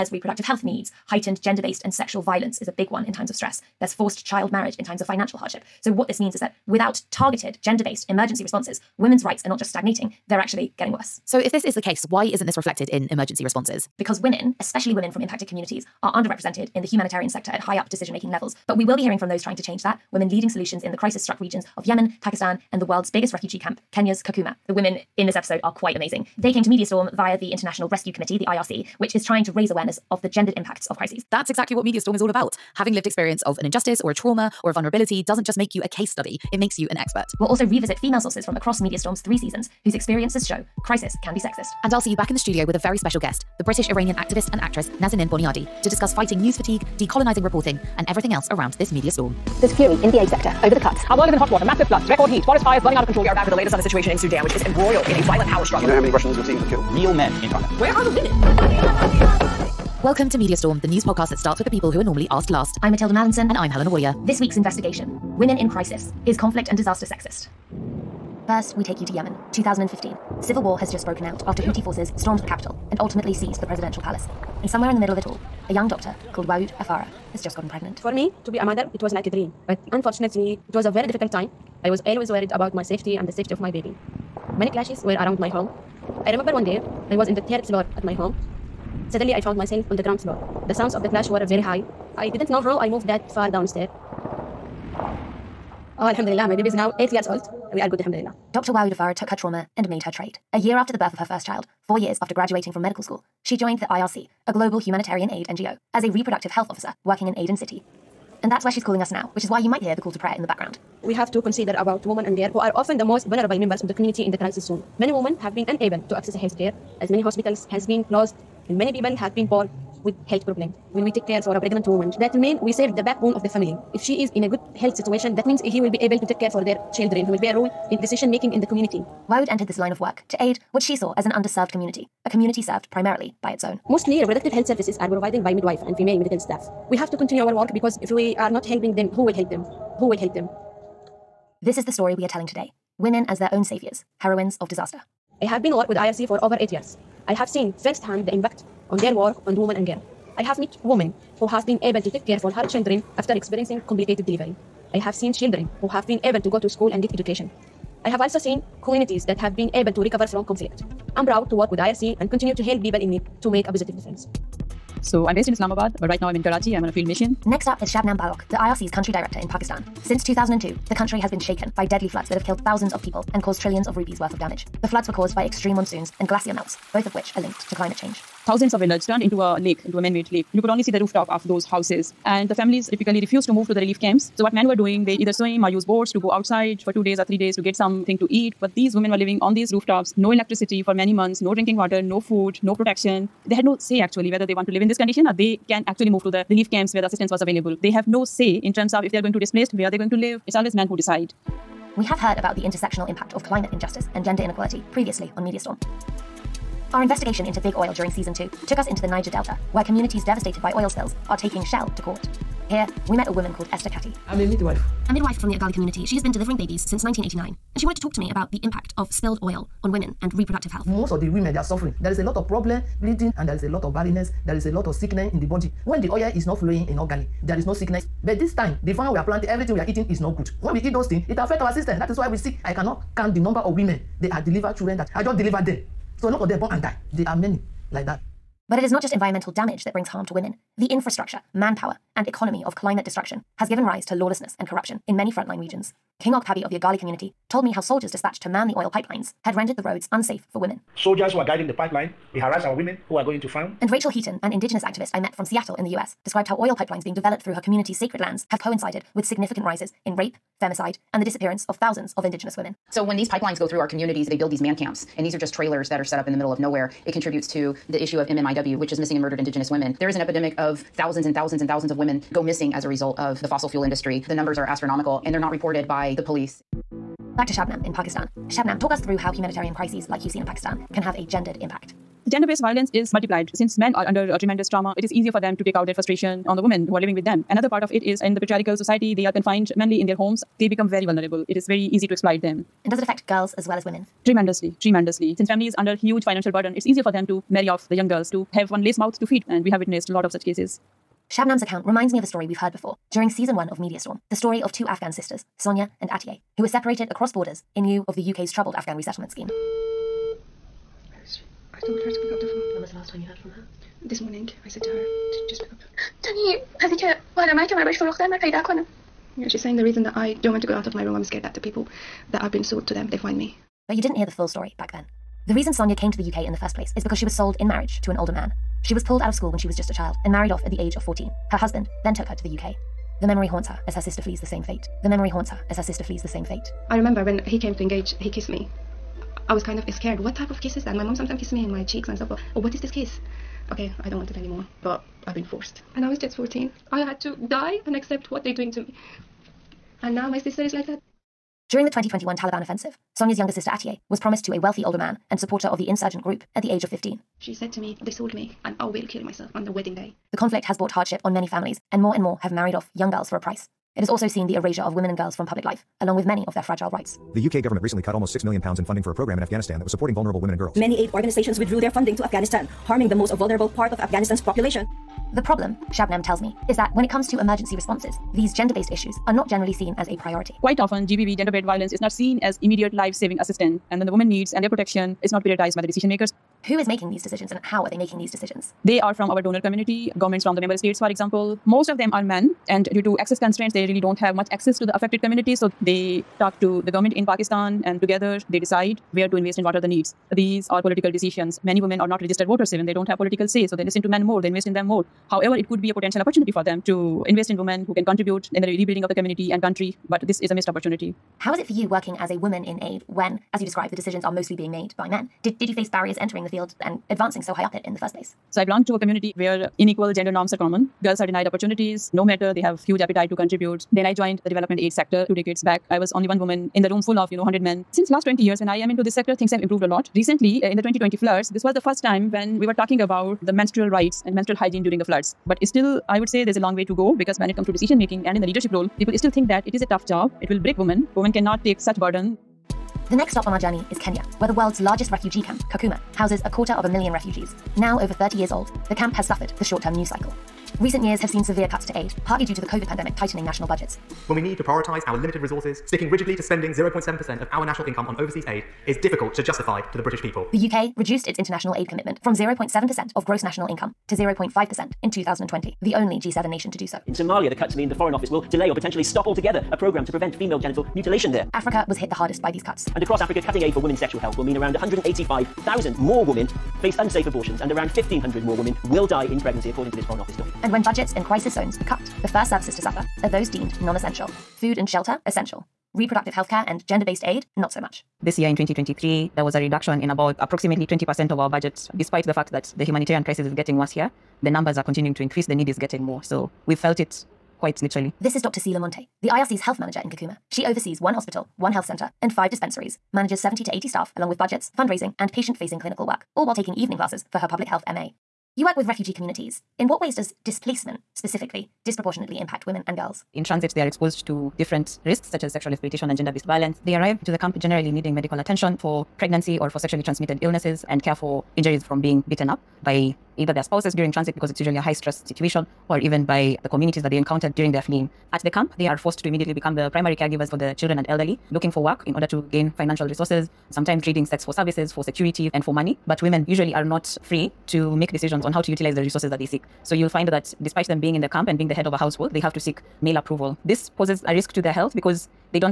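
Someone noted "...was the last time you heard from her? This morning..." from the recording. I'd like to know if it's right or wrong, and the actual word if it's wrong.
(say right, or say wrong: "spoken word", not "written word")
right.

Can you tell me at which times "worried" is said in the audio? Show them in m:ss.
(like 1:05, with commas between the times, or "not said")
1:22.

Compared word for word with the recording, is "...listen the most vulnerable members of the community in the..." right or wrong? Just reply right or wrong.
wrong.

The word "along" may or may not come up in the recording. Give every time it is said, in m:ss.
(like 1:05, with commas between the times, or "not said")
6:06, 8:24.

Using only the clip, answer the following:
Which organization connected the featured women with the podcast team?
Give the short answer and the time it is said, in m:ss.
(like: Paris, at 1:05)
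International Rescue Committee, at 0:27.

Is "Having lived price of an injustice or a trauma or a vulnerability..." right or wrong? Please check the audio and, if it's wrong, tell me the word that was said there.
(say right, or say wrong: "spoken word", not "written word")
wrong: "experience", not "price".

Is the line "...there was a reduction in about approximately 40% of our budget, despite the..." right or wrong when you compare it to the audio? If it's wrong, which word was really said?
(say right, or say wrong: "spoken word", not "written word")
wrong: "20", not "40".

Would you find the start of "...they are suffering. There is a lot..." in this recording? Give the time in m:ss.
3:41.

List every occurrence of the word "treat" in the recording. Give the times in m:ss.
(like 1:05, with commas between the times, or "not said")
not said.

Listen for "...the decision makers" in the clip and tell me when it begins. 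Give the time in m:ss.
6:25.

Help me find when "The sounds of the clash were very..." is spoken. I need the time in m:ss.
1:30.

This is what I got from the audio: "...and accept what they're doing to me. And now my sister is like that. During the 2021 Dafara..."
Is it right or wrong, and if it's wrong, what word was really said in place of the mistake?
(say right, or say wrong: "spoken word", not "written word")
wrong: "Taliban", not "Dafara".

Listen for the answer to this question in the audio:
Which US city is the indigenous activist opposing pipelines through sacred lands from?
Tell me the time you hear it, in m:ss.
4:15.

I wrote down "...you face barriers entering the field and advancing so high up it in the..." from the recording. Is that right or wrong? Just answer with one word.
right.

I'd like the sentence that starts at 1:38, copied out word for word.
Wau Dafara took her trauma and made her trade.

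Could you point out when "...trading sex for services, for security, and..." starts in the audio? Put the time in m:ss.
8:54.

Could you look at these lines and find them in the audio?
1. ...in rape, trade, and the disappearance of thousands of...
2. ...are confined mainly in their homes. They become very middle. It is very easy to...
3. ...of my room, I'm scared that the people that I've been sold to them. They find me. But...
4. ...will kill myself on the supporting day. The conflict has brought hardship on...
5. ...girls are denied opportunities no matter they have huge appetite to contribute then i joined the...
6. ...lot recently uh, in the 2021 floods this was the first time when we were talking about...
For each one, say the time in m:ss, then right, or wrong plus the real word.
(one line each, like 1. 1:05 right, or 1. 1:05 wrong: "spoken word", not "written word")
1. 4:20 wrong: "femicide", not "trade"
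2. 4:49 wrong: "vulnerable", not "middle"
3. 5:20 right
4. 5:58 wrong: "wedding", not "supporting"
5. 7:01 right
6. 7:09 wrong: "2020", not "2021".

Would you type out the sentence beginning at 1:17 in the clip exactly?
For me, to be a mother, it was like a dream.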